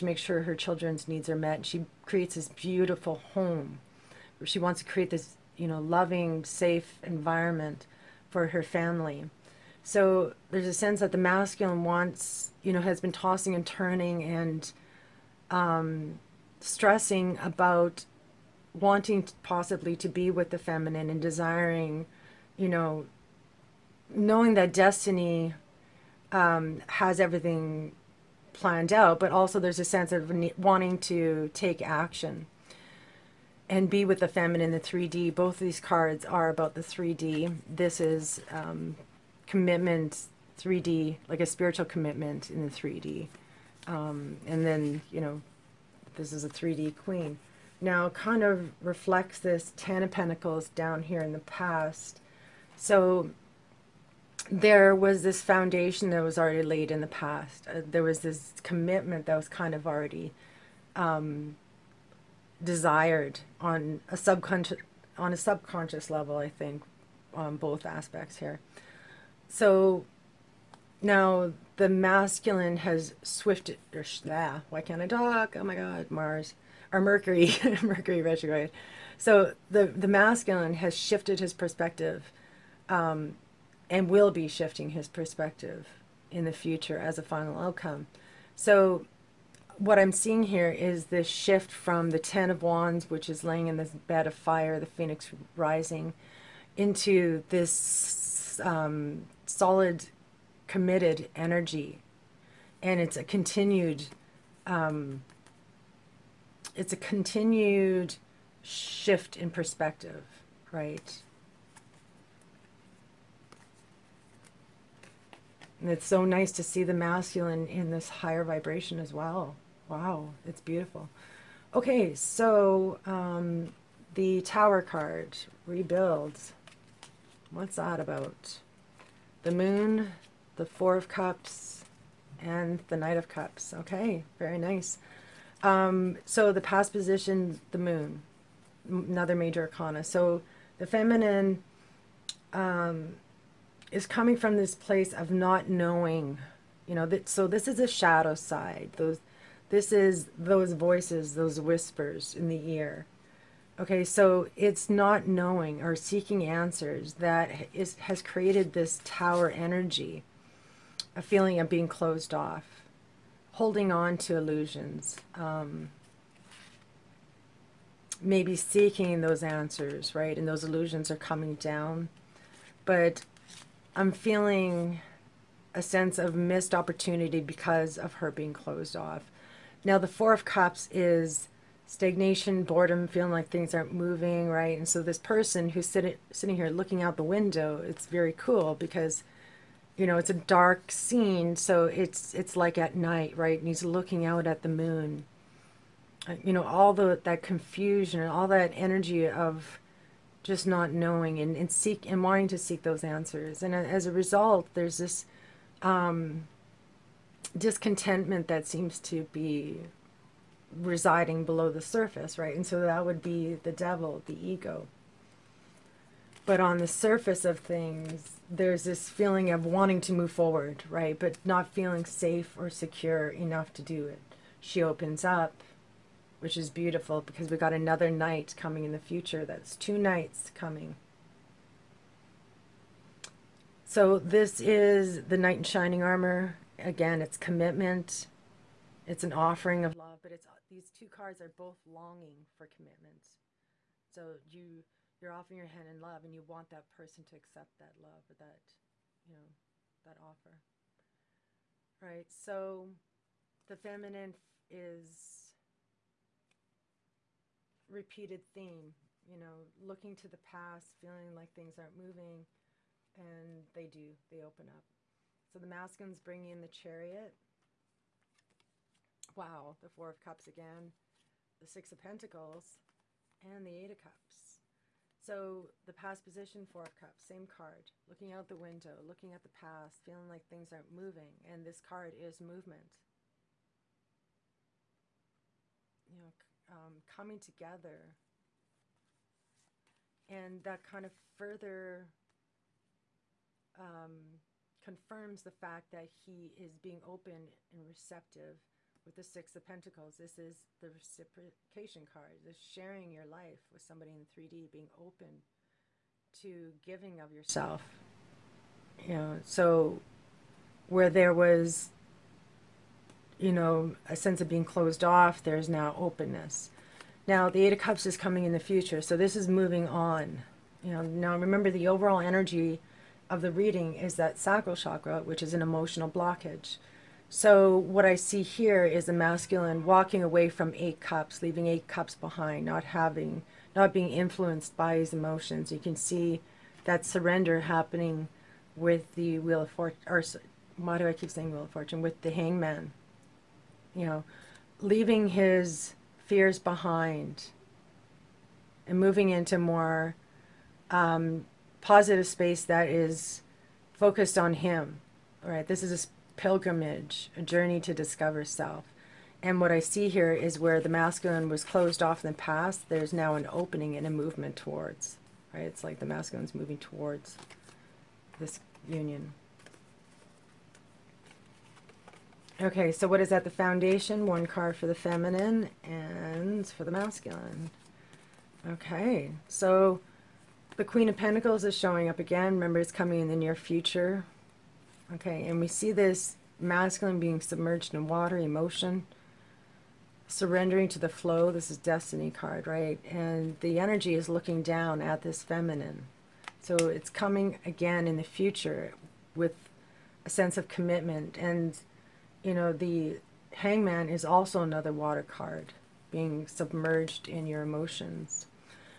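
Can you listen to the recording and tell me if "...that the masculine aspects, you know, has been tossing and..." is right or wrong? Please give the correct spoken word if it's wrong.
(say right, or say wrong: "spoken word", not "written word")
wrong: "wants", not "aspects".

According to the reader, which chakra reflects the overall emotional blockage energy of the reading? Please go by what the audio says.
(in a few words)
Sacral chakra.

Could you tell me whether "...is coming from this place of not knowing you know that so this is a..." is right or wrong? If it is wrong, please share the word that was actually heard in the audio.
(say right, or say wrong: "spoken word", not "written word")
right.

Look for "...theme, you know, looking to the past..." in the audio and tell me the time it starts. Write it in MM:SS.
04:18.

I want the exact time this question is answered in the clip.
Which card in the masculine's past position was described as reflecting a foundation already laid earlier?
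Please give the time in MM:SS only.
00:49.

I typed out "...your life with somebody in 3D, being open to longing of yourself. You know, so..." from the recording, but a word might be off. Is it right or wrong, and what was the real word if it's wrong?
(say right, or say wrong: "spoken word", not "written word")
wrong: "giving", not "longing".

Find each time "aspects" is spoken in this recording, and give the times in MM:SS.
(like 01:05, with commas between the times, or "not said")
01:07.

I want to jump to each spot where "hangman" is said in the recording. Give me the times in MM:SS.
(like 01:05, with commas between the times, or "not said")
05:42, 06:43.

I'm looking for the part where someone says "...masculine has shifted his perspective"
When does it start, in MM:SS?
01:20.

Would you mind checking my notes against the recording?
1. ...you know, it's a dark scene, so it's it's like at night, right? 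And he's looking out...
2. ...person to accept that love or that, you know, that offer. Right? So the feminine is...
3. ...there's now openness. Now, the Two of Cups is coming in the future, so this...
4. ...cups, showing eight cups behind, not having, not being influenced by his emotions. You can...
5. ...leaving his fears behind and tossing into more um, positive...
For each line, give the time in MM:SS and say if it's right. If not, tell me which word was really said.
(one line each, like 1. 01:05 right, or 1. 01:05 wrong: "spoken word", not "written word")
1. 03:09 right
2. 04:06 right
3. 05:15 wrong: "Eight", not "Two"
4. 05:30 wrong: "leaving", not "showing"
5. 05:44 wrong: "moving", not "tossing".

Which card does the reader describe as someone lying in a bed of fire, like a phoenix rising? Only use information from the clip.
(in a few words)
Ten of Wands.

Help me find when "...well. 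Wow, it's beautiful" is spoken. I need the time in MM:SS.
01:59.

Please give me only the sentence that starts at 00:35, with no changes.
Both these cards are about the 3D.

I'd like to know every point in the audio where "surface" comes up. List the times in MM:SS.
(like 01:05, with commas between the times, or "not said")
03:31, 03:36.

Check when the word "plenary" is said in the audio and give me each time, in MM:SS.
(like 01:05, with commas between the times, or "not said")
not said.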